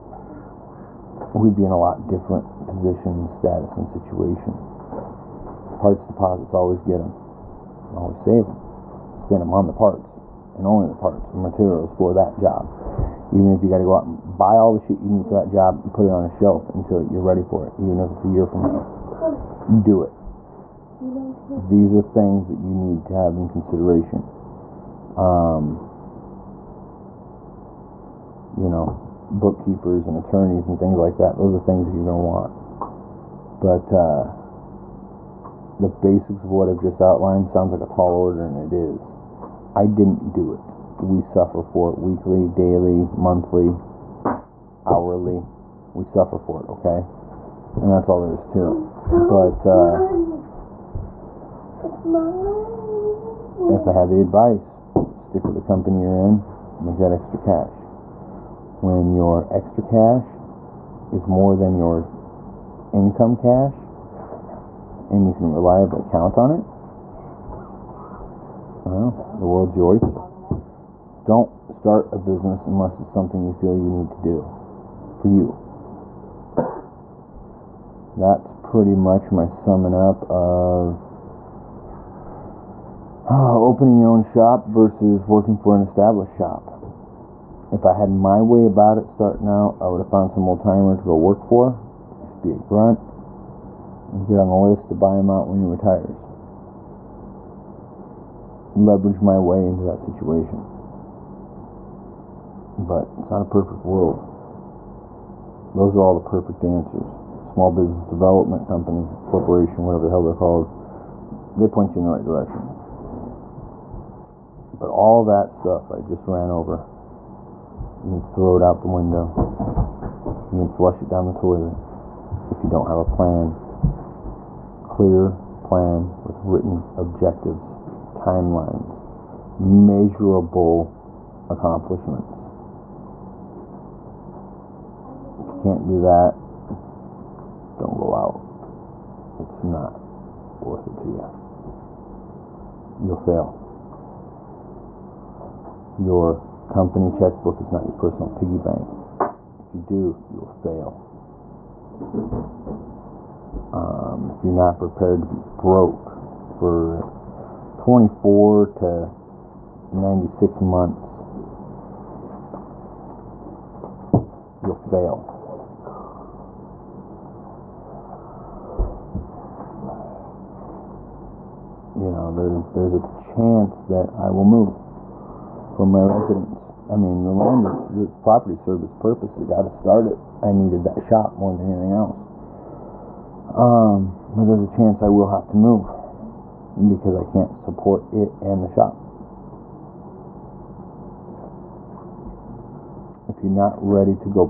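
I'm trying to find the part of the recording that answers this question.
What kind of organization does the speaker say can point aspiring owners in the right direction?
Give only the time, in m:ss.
1:47.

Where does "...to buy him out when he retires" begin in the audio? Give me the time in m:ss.
1:34.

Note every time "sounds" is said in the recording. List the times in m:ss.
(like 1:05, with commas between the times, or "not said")
0:37.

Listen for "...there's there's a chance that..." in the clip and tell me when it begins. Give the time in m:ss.
2:52.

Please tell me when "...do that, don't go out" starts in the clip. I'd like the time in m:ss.
2:15.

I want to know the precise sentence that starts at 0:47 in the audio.
And that's all there is to it.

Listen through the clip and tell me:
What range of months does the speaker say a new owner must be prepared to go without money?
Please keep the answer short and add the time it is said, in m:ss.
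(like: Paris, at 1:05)
24 to 96 months, at 2:37.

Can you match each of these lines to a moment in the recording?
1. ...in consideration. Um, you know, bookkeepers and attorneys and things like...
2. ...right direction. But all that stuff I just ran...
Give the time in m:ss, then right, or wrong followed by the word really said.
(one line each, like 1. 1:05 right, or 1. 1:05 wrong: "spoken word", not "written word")
1. 0:23 right
2. 1:52 right.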